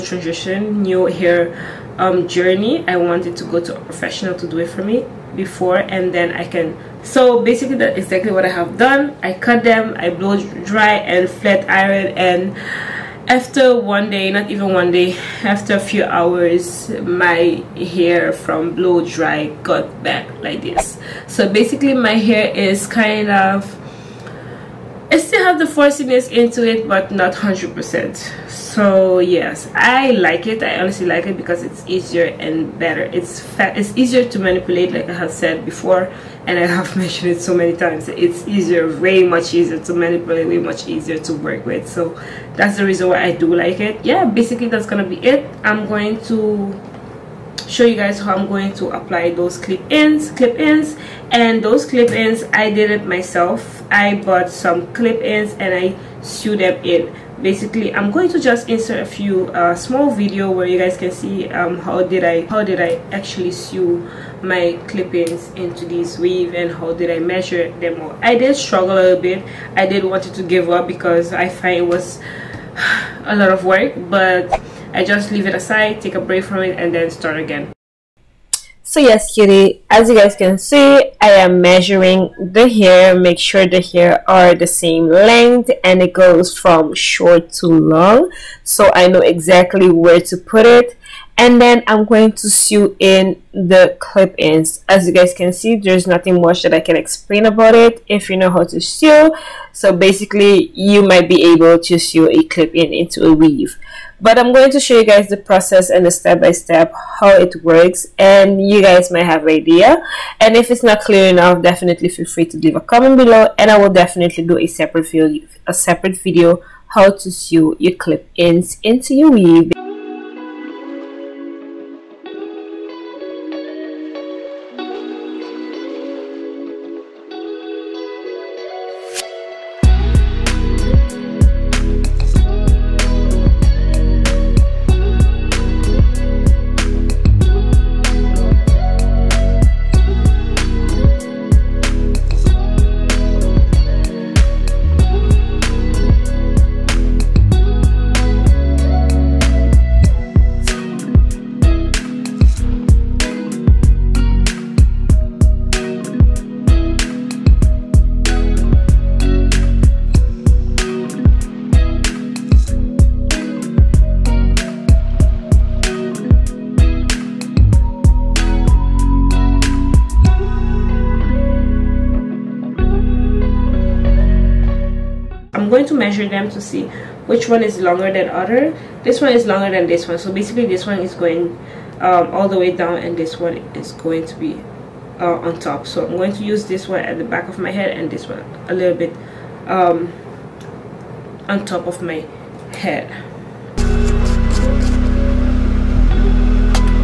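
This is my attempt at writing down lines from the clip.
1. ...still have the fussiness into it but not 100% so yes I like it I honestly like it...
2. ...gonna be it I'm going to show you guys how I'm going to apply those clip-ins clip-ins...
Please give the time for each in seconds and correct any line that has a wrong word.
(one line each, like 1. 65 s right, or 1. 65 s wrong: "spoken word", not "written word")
1. 25 s right
2. 44 s right.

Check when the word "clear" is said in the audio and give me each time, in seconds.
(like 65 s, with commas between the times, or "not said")
111 s.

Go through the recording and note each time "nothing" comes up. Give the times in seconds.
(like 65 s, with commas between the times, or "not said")
96 s.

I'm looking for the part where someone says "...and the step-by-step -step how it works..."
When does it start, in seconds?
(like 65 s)
105 s.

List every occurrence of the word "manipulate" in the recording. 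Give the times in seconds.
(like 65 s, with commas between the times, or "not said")
34 s, 39 s.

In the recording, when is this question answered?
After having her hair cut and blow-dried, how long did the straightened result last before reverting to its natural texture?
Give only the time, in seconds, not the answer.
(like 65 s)
15 s.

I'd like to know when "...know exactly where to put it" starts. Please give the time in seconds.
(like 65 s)
89 s.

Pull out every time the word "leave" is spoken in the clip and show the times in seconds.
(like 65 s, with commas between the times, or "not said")
75 s, 112 s.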